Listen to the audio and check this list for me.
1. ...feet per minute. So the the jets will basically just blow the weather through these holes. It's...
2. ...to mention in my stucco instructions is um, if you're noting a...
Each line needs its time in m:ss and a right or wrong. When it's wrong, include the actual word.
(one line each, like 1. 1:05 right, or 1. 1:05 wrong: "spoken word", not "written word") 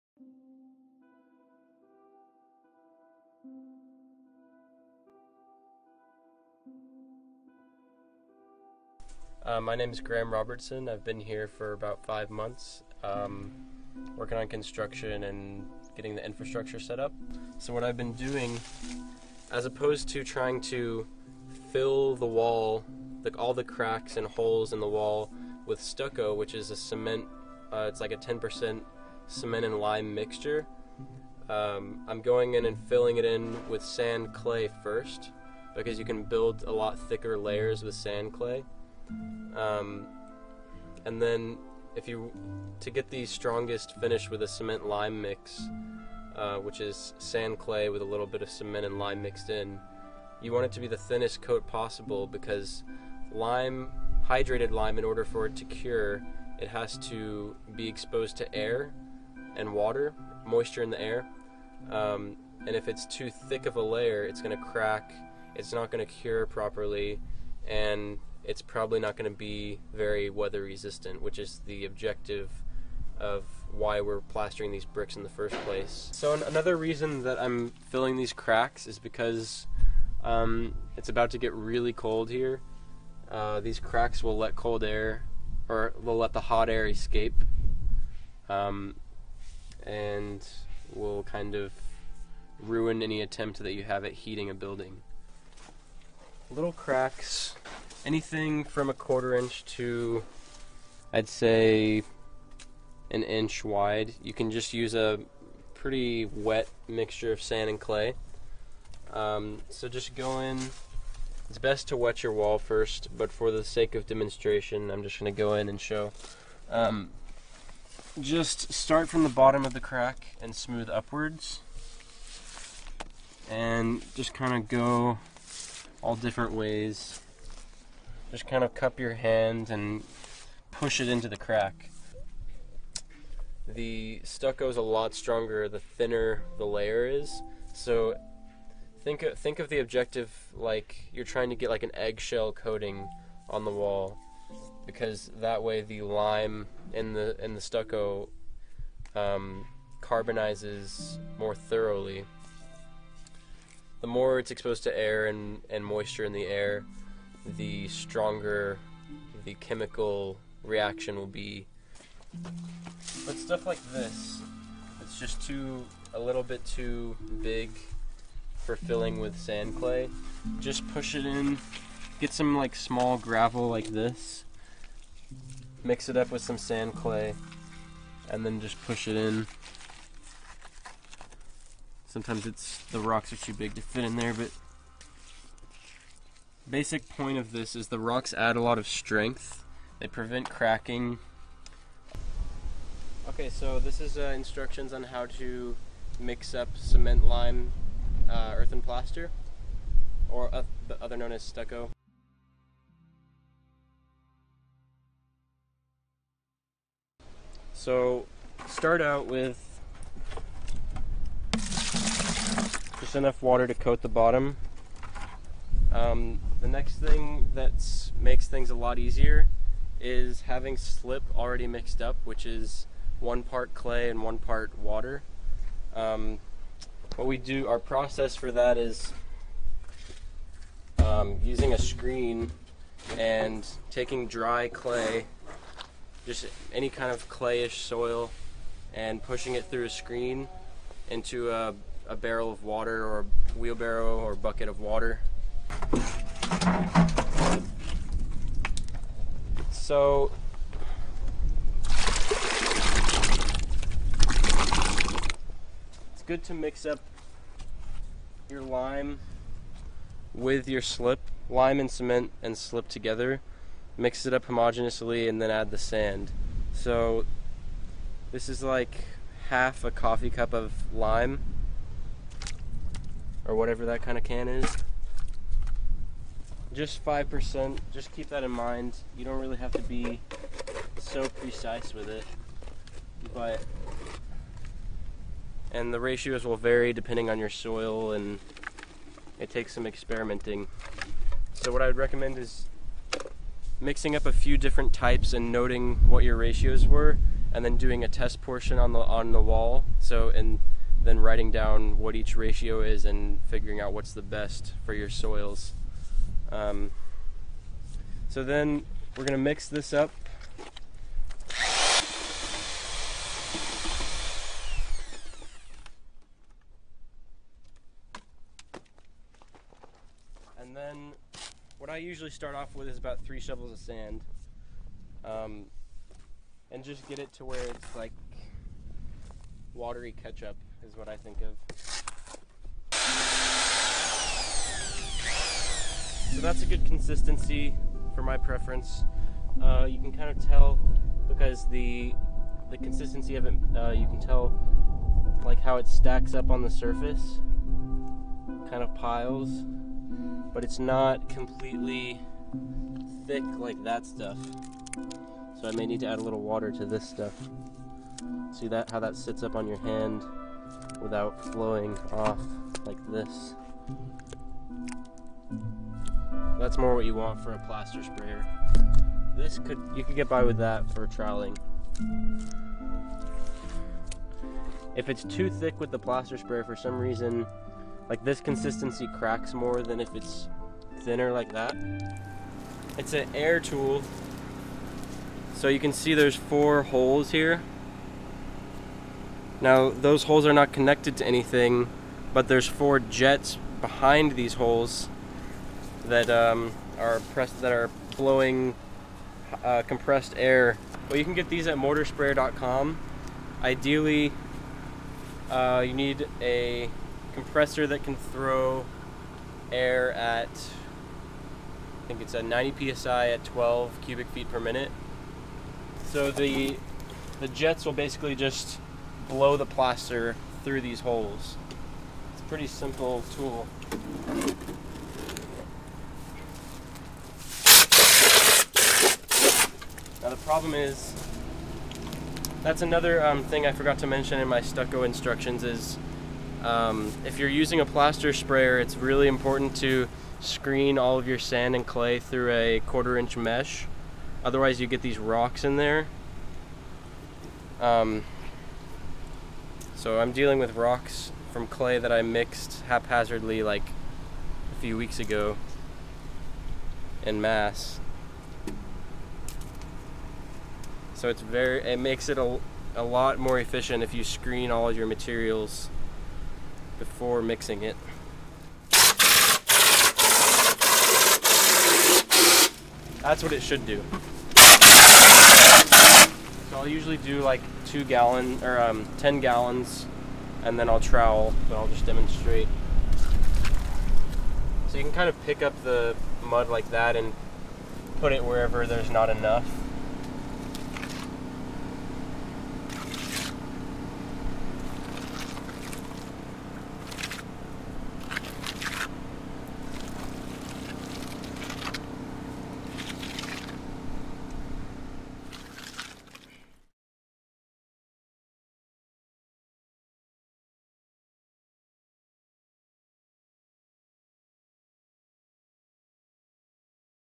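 1. 6:54 wrong: "plaster", not "weather"
2. 7:13 wrong: "using", not "noting".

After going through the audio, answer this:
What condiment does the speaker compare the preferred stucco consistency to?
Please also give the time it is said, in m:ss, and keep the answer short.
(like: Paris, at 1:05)
Watery ketchup, at 5:29.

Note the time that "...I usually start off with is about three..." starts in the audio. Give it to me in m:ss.
5:21.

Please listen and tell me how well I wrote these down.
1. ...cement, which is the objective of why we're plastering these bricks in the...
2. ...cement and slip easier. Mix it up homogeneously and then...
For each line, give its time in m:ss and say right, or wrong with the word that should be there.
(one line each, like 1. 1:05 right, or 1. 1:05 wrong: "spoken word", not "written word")
1. 1:10 wrong: "resistant", not "cement"
2. 4:21 wrong: "together", not "easier".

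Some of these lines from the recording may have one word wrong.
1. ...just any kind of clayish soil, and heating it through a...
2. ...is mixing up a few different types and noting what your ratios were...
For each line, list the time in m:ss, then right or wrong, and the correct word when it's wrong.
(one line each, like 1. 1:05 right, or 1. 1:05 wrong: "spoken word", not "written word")
1. 3:56 wrong: "pushing", not "heating"
2. 4:52 right.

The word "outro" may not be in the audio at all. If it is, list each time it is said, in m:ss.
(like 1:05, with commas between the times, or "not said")
not said.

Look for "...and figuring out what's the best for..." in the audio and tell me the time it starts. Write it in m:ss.
5:03.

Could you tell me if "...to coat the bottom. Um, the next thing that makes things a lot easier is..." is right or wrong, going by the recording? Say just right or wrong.
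right.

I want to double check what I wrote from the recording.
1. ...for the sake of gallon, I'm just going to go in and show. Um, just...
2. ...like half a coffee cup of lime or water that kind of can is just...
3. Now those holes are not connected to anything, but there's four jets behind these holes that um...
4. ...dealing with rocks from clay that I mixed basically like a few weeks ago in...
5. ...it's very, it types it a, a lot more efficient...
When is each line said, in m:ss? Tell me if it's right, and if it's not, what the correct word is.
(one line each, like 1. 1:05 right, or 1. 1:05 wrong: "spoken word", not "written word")
1. 1:53 wrong: "demonstration", not "gallon"
2. 4:28 wrong: "whatever", not "water"
3. 6:29 right
4. 7:30 wrong: "haphazardly", not "basically"
5. 7:41 wrong: "makes", not "types".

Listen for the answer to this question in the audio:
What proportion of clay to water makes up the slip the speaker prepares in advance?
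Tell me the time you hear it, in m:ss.
3:43.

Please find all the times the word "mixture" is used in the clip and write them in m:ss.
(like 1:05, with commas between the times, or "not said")
0:30, 1:46.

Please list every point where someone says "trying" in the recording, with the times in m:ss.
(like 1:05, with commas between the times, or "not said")
0:20, 2:21.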